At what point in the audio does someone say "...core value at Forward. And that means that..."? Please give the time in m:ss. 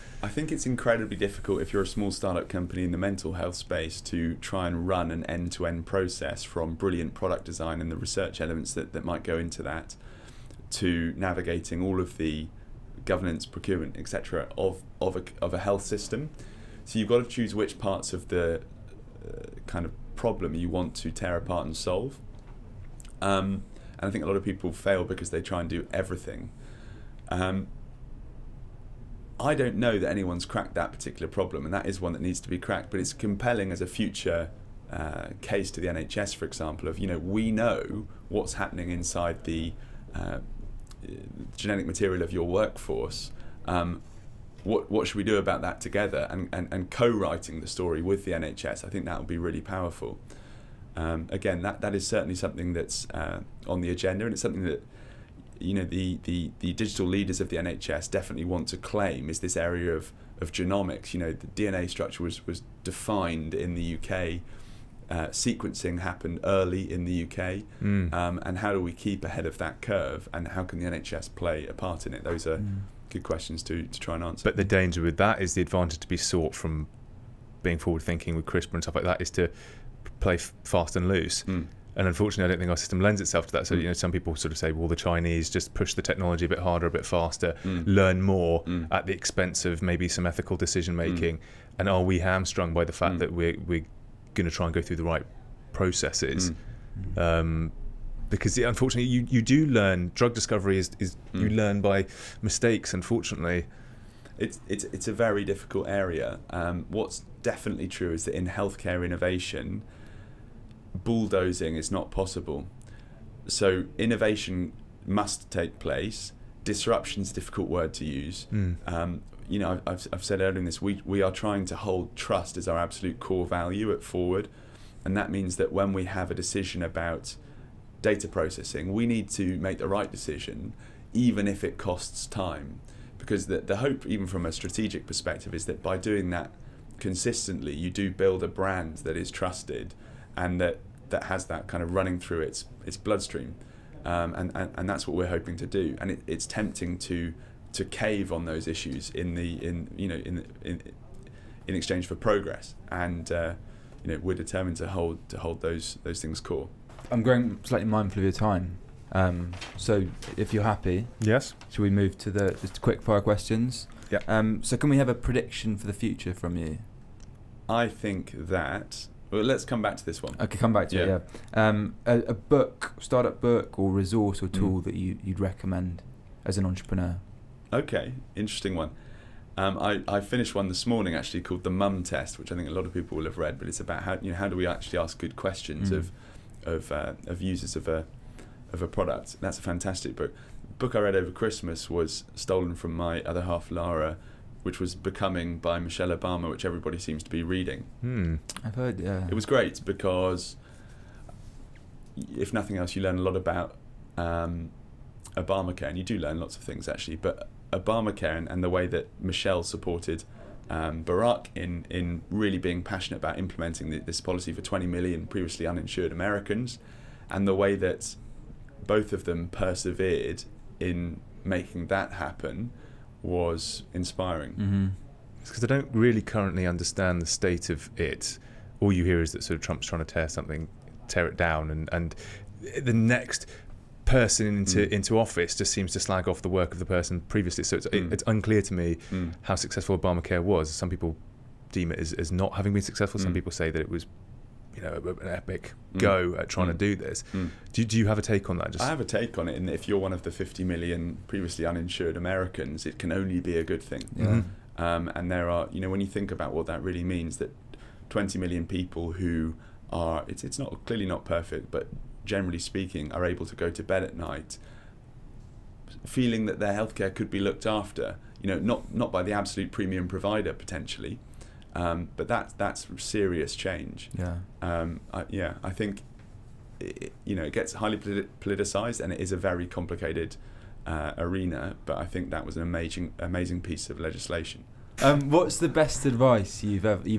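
2:03.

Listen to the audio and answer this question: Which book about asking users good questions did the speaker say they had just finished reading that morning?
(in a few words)
The Mum Test.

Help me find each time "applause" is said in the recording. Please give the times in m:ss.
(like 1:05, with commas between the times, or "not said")
not said.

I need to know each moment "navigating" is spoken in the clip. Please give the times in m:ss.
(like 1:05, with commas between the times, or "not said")
0:11.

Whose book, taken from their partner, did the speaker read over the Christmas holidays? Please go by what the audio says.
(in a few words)
Michelle Obama.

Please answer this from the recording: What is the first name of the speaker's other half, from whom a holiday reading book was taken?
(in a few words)
Lara.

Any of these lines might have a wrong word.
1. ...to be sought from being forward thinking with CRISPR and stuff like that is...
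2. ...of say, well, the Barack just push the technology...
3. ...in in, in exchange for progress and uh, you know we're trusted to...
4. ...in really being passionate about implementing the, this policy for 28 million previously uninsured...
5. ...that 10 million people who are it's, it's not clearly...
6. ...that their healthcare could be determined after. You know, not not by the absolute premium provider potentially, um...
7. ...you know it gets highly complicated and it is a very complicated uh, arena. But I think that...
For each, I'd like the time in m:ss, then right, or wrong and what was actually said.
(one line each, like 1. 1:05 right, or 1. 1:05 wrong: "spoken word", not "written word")
1. 1:16 right
2. 1:24 wrong: "Chinese", not "Barack"
3. 2:30 wrong: "determined", not "trusted"
4. 3:31 wrong: "20", not "28"
5. 4:17 wrong: "20", not "10"
6. 4:26 wrong: "looked", not "determined"
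7. 4:37 wrong: "politicized", not "complicated".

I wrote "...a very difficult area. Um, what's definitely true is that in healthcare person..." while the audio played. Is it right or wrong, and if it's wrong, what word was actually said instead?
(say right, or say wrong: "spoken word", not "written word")
wrong: "innovation", not "person".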